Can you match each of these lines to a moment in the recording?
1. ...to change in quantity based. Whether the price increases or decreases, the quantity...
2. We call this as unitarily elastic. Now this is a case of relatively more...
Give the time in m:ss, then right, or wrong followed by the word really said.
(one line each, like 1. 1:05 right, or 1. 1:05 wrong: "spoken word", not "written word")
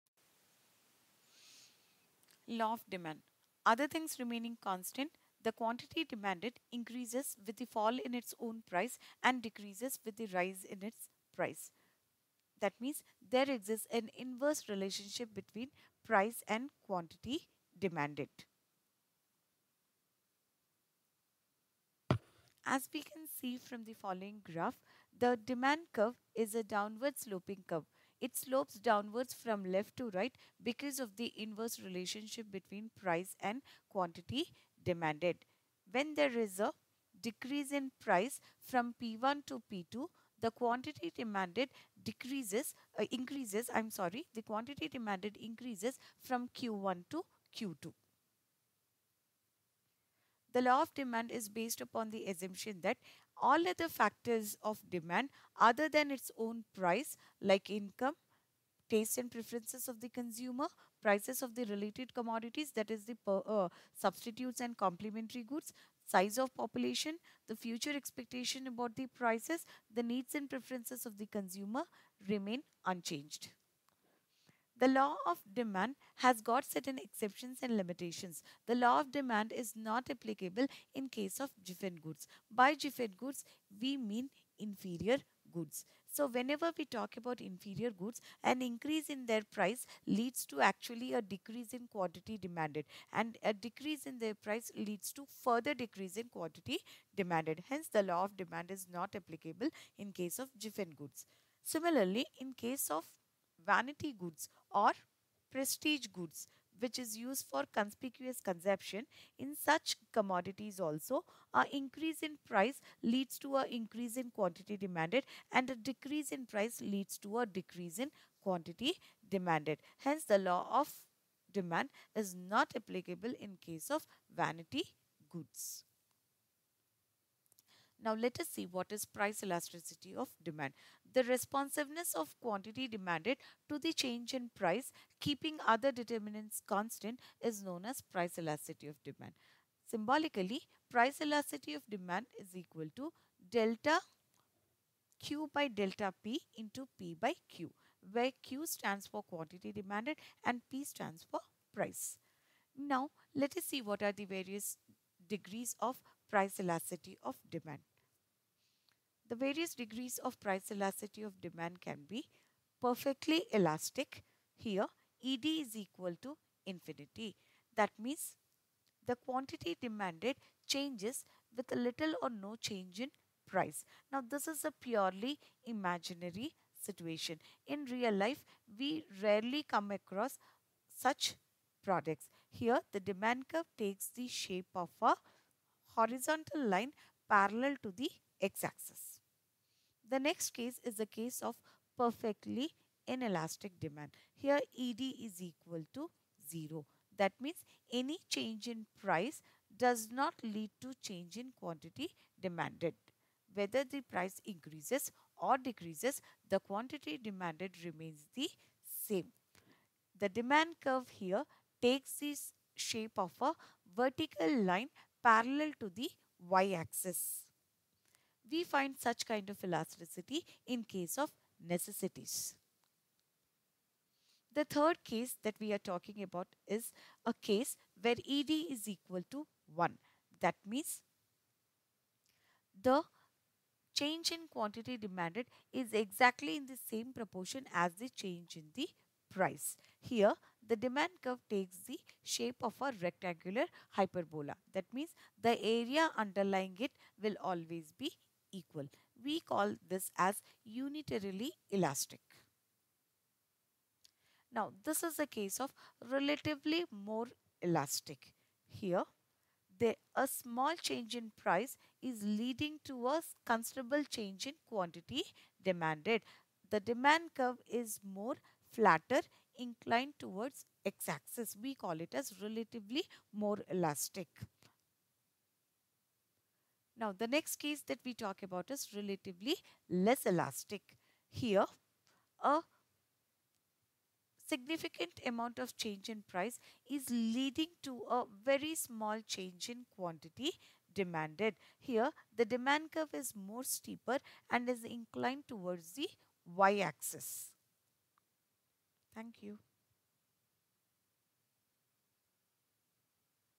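1. 3:20 wrong: "demanded", not "based"
2. 4:09 right.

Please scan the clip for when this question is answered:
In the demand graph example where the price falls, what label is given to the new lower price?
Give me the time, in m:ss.
0:39.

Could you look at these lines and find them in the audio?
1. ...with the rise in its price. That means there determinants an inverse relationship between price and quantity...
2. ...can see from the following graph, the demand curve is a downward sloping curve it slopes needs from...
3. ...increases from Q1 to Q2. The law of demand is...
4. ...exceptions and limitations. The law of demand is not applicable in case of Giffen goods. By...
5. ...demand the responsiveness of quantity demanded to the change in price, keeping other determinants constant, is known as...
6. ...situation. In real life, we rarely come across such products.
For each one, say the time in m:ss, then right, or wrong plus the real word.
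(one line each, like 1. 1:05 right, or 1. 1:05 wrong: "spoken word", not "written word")
1. 0:10 wrong: "exists", not "determinants"
2. 0:23 wrong: "downwards", not "needs"
3. 0:45 right
4. 1:16 right
5. 2:10 right
6. 2:56 right.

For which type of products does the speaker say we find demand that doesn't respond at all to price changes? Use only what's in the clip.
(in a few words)
necessities.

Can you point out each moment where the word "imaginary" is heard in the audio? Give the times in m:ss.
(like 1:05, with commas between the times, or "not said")
2:55.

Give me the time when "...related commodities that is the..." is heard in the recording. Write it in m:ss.
1:01.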